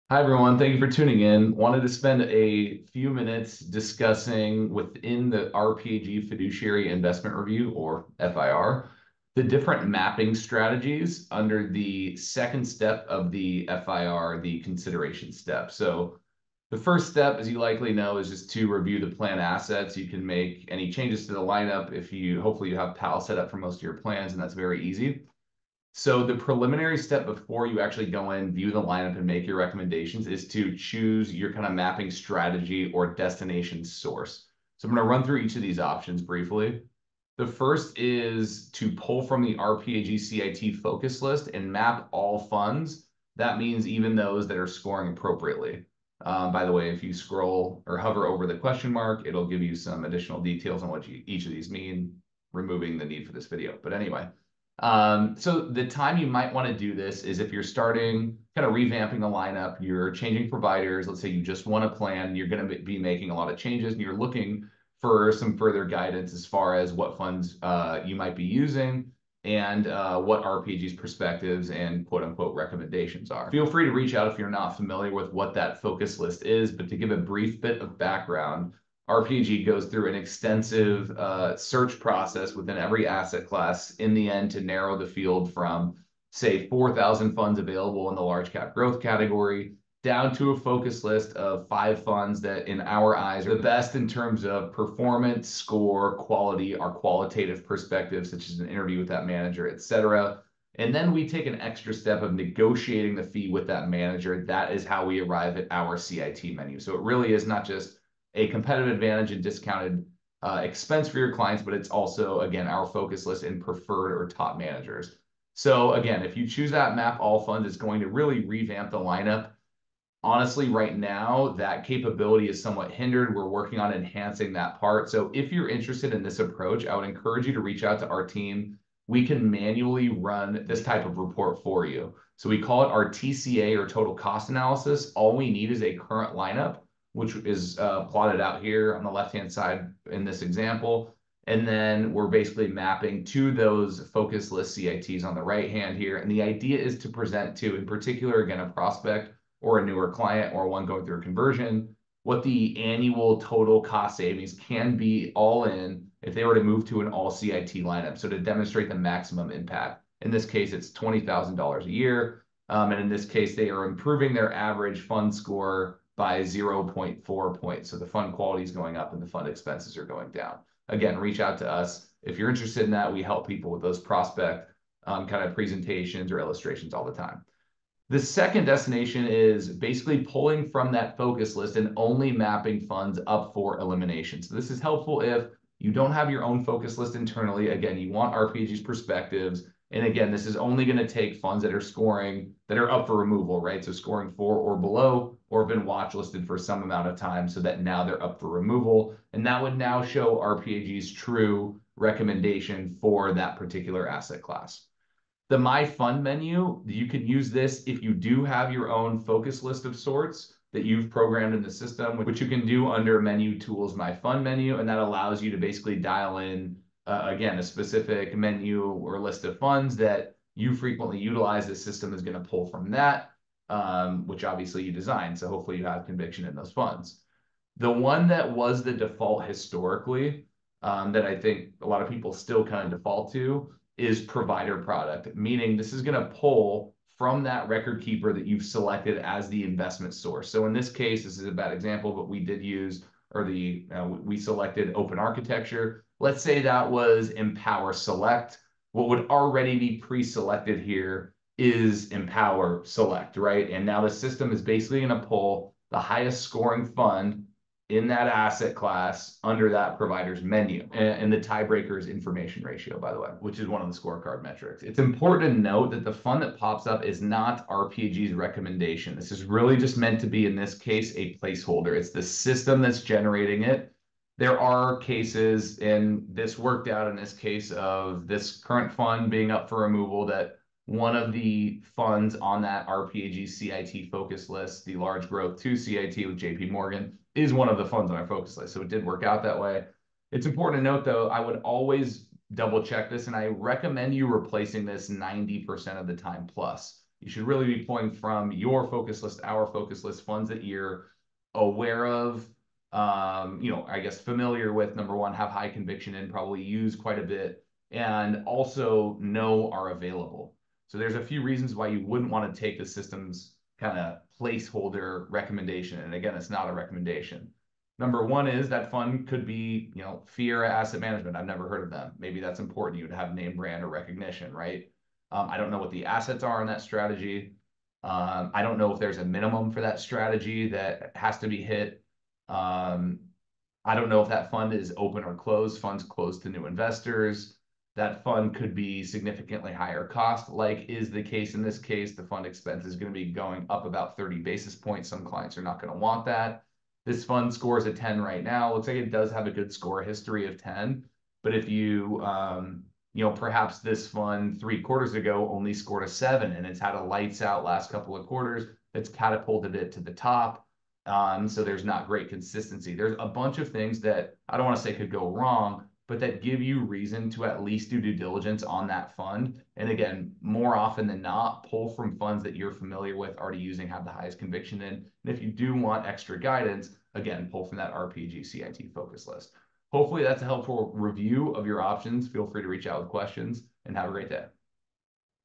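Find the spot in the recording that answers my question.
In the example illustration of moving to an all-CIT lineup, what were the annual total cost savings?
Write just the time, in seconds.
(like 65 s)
160 s.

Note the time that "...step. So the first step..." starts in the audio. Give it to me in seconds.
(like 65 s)
15 s.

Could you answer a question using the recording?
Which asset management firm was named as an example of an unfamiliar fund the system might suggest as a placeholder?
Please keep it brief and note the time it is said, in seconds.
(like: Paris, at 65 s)
Fiera Asset Management, at 320 s.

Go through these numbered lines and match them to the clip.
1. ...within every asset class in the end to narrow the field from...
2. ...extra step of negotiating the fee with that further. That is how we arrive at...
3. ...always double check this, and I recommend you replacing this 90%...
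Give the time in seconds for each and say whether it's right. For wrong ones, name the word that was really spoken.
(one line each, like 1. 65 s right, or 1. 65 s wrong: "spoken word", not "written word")
1. 82 s right
2. 101 s wrong: "manager", not "further"
3. 291 s right.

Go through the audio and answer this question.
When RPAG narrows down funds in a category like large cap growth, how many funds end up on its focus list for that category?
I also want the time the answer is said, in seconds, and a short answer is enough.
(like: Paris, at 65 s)
5, at 91 s.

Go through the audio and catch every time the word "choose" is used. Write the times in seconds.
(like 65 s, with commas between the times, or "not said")
30 s, 116 s.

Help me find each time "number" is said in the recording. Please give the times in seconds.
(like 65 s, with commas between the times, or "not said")
304 s, 317 s.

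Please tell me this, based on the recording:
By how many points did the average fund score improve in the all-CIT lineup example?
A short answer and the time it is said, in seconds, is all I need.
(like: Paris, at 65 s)
0.4, at 166 s.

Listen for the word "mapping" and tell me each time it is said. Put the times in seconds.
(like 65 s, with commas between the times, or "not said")
9 s, 31 s, 142 s, 182 s.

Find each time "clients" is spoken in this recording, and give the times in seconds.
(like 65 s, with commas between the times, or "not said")
111 s, 150 s, 345 s.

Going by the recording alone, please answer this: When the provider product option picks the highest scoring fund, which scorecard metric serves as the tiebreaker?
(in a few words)
information ratio.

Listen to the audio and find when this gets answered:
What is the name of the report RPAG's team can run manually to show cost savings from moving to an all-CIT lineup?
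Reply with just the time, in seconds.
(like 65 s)
133 s.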